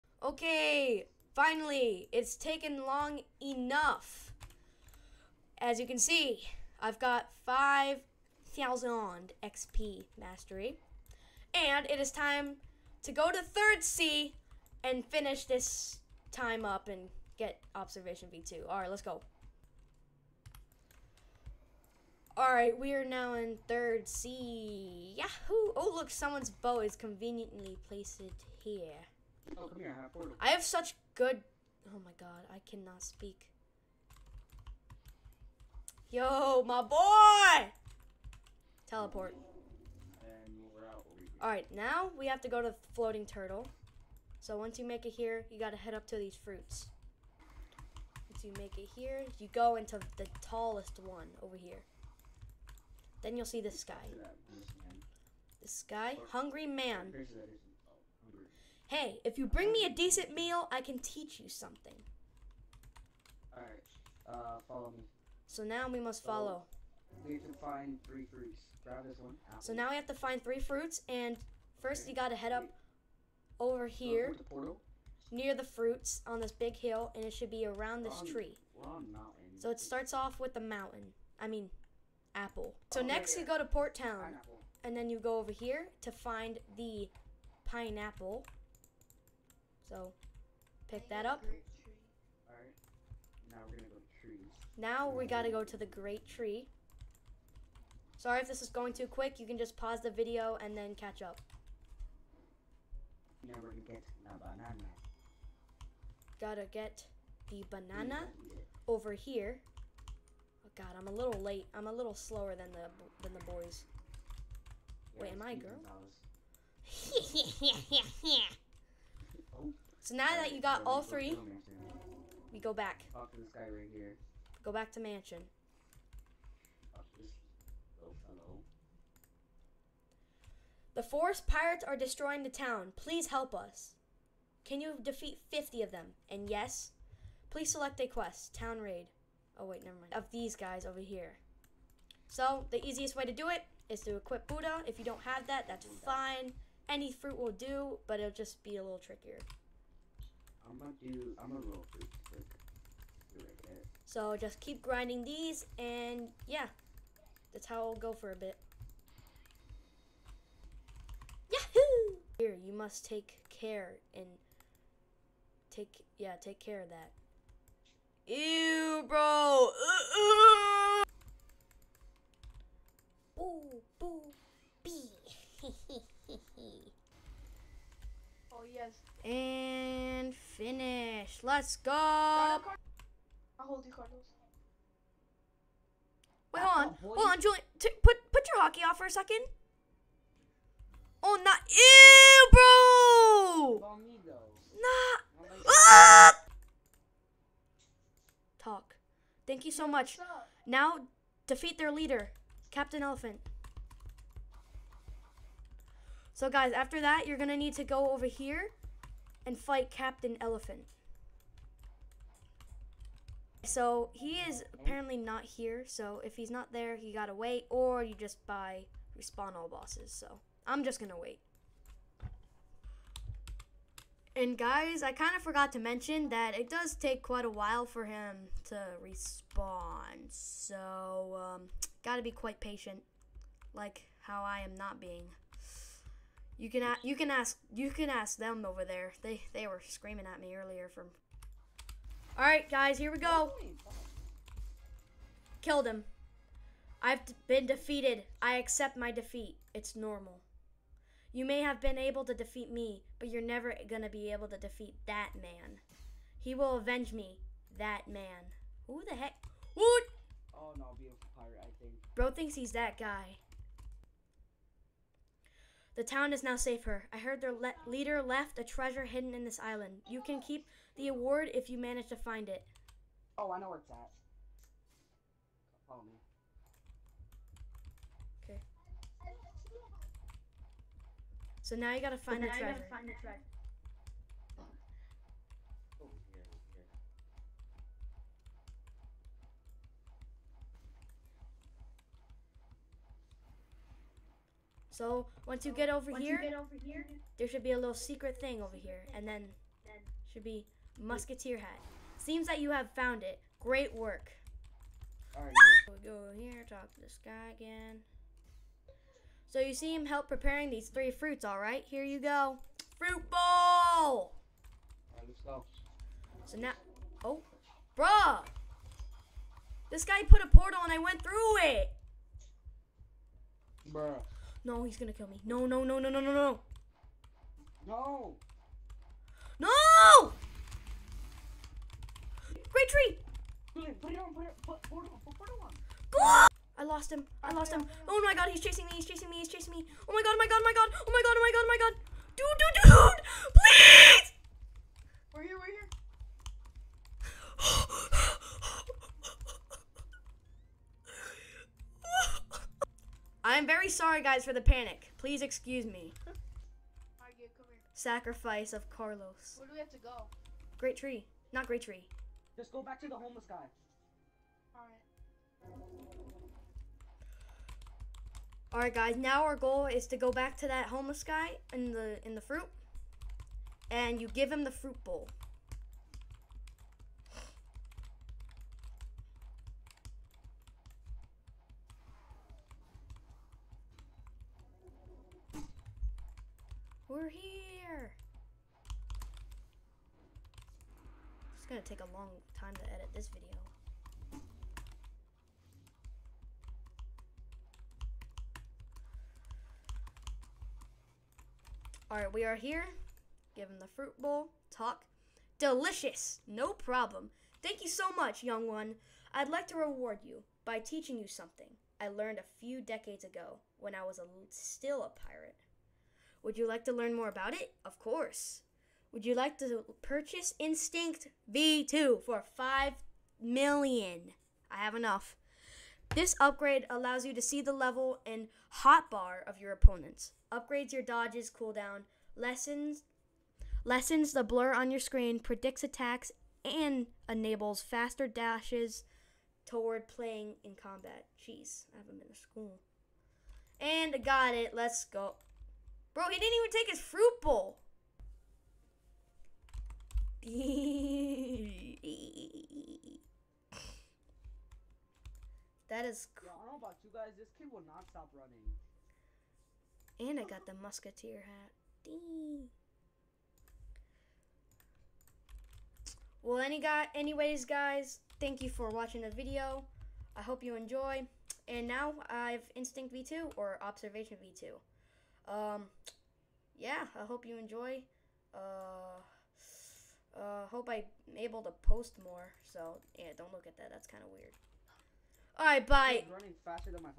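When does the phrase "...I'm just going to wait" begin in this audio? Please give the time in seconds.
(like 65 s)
220 s.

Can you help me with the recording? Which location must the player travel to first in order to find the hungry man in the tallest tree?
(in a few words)
Floating Turtle.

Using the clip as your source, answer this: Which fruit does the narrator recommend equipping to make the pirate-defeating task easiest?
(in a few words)
Buddha.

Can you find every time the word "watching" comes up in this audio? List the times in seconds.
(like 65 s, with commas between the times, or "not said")
468 s.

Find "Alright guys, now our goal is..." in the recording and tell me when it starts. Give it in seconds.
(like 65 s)
368 s.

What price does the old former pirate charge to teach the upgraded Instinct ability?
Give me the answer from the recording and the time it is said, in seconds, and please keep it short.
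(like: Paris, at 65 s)
5 million, at 422 s.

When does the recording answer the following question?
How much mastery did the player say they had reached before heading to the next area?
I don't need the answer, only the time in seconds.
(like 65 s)
7 s.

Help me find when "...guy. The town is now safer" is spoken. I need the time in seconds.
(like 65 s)
262 s.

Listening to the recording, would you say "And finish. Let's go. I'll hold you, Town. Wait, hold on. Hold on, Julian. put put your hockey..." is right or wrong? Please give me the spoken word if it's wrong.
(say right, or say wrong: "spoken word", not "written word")
wrong: "Carlos", not "Town".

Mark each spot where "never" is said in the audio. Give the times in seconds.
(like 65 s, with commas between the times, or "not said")
139 s, 253 s.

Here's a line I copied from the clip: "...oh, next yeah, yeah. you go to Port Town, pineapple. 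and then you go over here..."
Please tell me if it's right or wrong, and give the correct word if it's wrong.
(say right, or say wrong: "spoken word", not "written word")
right.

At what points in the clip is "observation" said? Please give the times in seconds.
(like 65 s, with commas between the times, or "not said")
17 s, 473 s.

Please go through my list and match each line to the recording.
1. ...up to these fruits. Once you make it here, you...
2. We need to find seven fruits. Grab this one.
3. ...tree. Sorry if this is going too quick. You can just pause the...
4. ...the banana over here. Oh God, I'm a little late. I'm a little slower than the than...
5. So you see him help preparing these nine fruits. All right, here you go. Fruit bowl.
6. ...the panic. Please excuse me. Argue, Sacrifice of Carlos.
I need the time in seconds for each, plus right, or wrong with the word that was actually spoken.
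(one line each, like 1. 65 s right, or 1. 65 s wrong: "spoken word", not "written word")
1. 45 s right
2. 67 s wrong: "three", not "seven"
3. 96 s right
4. 107 s right
5. 309 s wrong: "three", not "nine"
6. 354 s right.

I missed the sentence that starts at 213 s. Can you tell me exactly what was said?
So he is apparently not here.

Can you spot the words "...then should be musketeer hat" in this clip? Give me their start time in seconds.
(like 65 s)
299 s.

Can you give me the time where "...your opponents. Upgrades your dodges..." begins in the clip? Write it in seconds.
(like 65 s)
429 s.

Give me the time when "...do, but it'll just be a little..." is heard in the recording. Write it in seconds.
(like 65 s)
147 s.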